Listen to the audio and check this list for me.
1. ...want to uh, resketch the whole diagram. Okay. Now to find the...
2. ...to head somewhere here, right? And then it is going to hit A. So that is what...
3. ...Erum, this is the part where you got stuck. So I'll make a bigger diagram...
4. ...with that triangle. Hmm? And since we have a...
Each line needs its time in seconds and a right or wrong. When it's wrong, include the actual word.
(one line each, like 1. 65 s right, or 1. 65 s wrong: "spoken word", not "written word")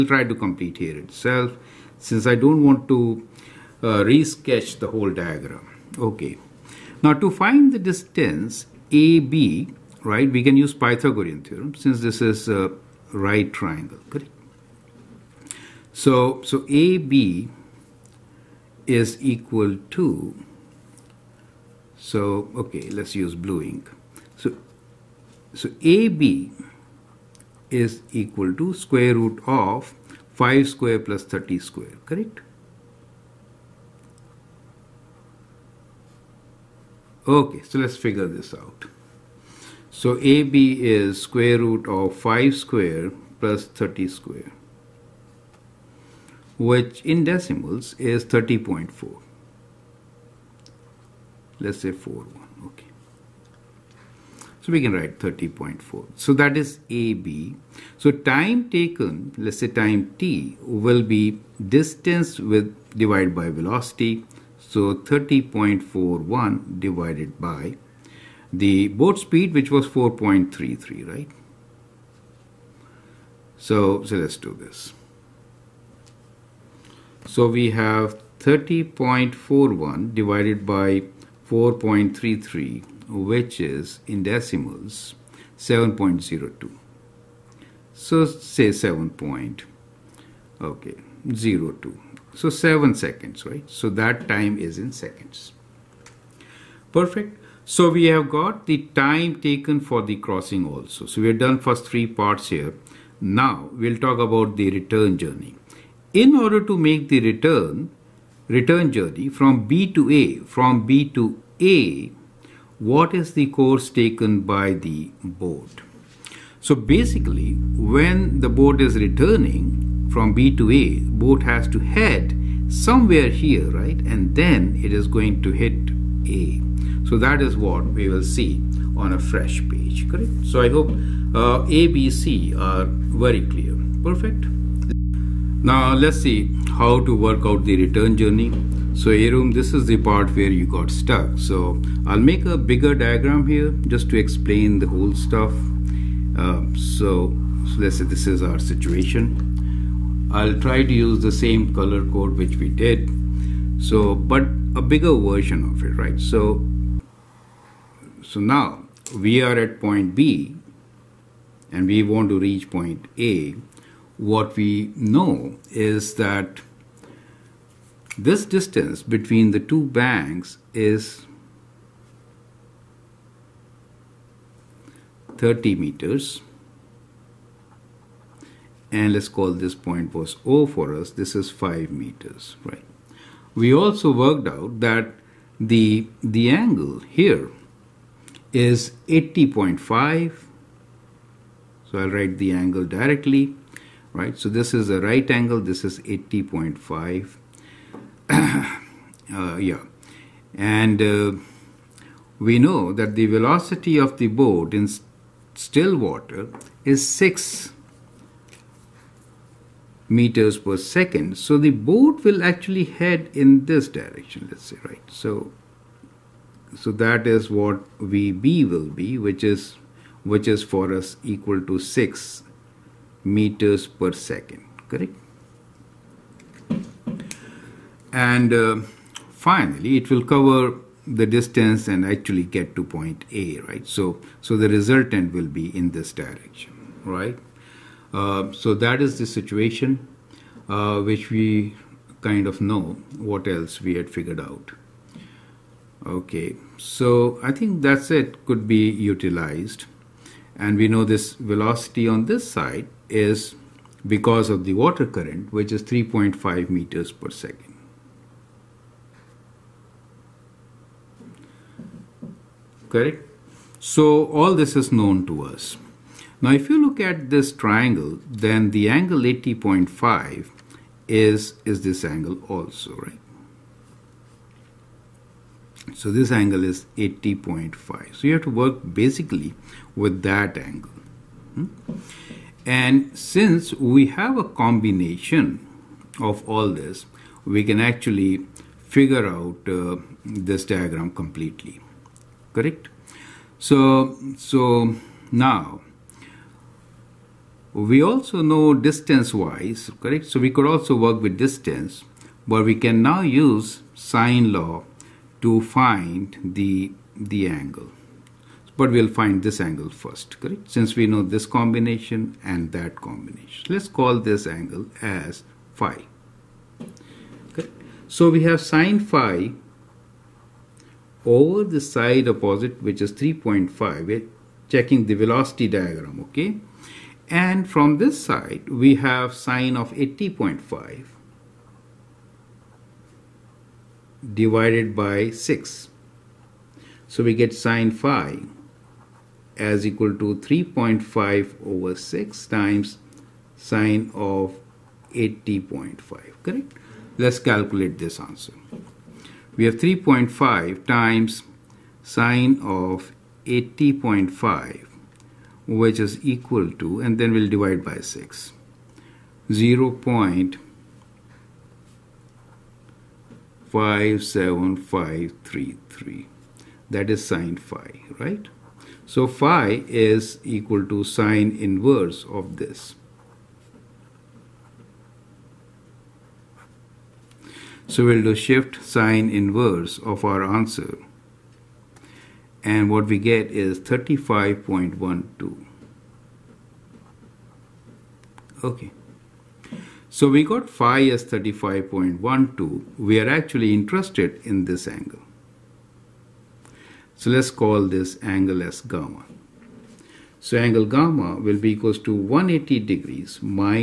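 1. 2 s right
2. 121 s right
3. 139 s right
4. 279 s wrong: "angle", not "triangle".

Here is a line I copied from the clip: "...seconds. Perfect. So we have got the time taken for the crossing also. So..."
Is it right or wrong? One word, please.
right.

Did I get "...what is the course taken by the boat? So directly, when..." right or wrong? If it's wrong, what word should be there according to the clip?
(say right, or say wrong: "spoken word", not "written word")
wrong: "basically", not "directly".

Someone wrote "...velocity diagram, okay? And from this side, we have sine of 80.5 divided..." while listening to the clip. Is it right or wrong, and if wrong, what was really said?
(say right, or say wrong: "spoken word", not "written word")
right.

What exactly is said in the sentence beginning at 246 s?
Okay, so I think that's it could be utilized.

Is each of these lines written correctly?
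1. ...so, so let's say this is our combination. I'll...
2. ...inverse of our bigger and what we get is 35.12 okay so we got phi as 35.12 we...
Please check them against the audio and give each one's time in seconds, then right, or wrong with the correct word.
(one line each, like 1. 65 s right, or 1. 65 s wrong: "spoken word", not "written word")
1. 146 s wrong: "situation", not "combination"
2. 379 s wrong: "answer", not "bigger".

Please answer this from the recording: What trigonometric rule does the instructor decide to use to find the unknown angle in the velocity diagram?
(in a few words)
sine law.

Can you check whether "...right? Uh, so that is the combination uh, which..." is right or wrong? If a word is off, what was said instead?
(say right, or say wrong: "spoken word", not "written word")
wrong: "situation", not "combination".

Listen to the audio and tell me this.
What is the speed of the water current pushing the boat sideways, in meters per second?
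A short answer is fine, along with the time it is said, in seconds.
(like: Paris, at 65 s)
3.5 meters per second, at 255 s.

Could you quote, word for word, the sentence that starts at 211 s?
So the boat will actually head in this direction, let's say, right?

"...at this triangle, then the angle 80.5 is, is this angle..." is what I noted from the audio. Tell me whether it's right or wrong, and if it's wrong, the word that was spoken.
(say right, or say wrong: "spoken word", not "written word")
right.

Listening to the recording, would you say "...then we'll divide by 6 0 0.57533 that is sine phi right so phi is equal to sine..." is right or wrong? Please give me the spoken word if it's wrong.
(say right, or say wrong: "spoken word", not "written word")
right.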